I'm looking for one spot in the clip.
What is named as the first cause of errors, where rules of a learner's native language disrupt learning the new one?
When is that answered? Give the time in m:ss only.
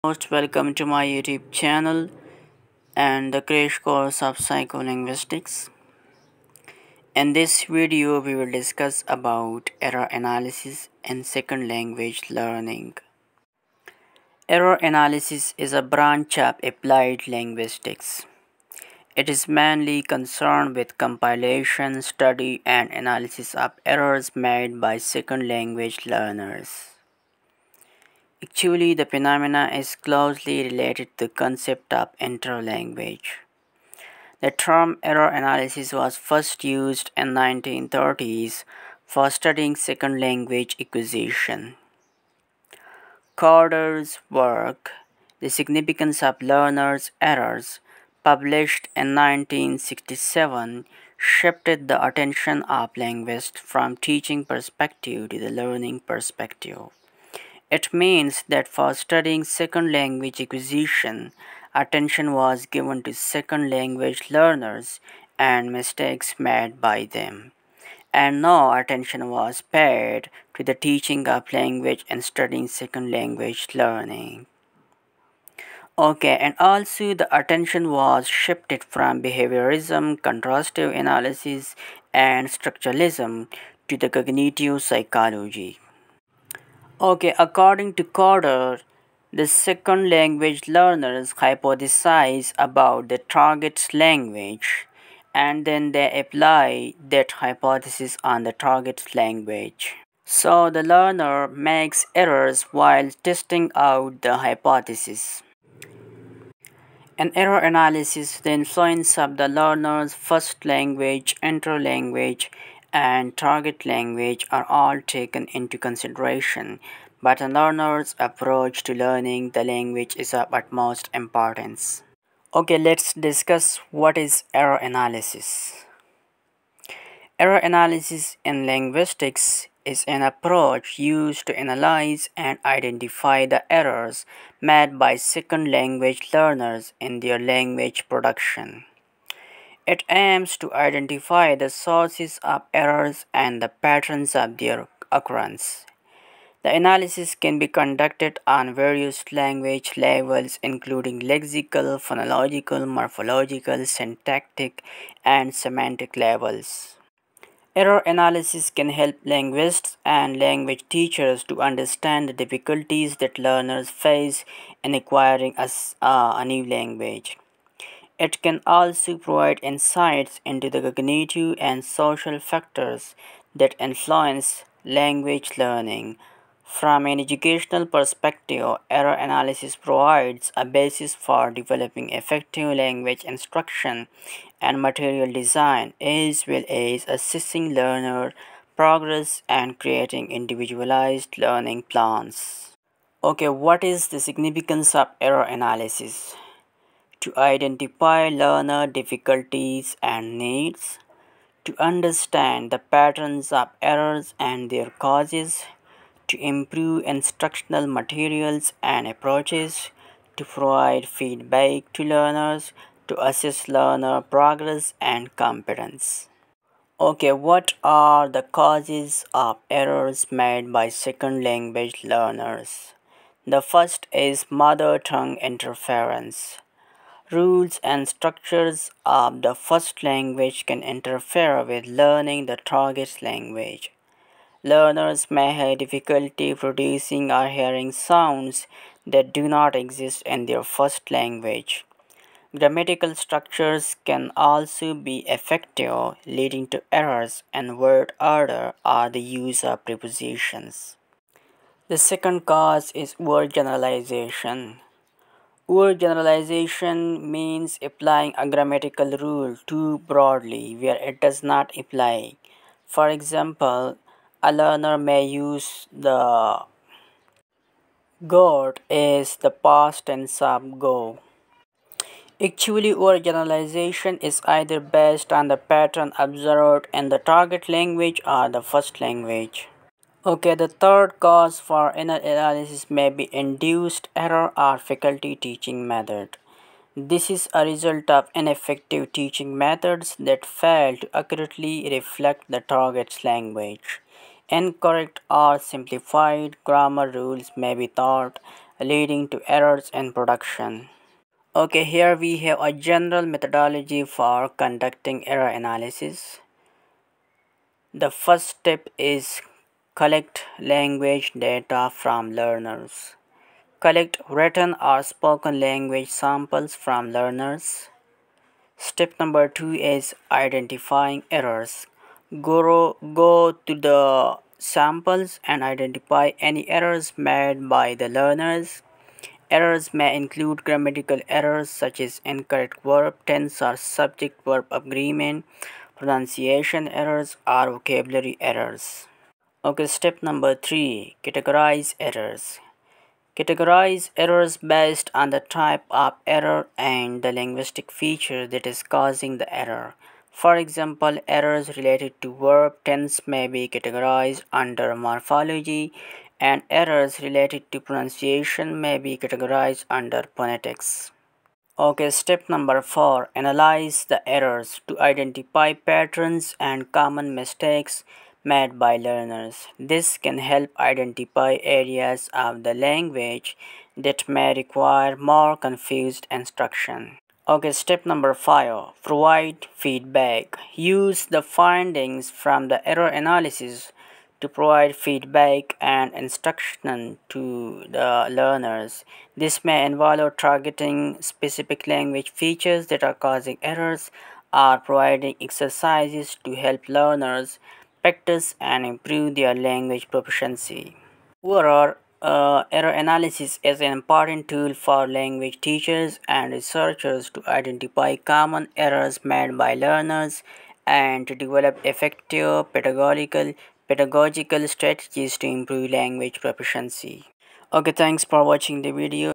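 3:44.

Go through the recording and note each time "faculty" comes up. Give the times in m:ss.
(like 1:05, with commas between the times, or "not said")
4:44.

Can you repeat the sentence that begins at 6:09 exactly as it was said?
This can help identify areas of the language that may require more confused instruction.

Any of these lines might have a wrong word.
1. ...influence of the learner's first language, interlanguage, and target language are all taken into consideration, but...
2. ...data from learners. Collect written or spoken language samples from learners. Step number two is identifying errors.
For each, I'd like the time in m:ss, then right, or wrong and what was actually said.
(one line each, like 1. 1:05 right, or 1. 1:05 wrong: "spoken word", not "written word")
1. 1:48 right
2. 5:11 right.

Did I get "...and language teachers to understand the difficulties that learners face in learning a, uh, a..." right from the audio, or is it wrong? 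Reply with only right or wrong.
wrong.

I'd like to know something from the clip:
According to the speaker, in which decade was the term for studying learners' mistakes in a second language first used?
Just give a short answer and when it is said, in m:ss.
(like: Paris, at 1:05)
1930s, at 0:37.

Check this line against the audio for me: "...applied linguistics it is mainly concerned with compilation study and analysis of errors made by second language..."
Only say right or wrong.
right.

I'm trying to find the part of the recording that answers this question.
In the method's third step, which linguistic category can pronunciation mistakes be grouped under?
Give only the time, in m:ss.
6:00.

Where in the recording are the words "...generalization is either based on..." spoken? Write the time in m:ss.
4:33.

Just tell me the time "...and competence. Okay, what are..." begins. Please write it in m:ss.
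3:34.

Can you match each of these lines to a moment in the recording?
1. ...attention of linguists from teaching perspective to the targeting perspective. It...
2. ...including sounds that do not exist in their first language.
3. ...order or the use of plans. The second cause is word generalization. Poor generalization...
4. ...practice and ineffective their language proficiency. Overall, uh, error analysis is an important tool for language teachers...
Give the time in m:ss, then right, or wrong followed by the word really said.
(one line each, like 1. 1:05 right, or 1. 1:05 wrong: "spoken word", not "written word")
1. 0:52 wrong: "learning", not "targeting"
2. 3:57 wrong: "hearing", not "including"
3. 4:08 wrong: "prepositions", not "plans"
4. 6:38 wrong: "improve", not "ineffective".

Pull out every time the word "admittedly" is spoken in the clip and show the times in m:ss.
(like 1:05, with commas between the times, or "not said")
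not said.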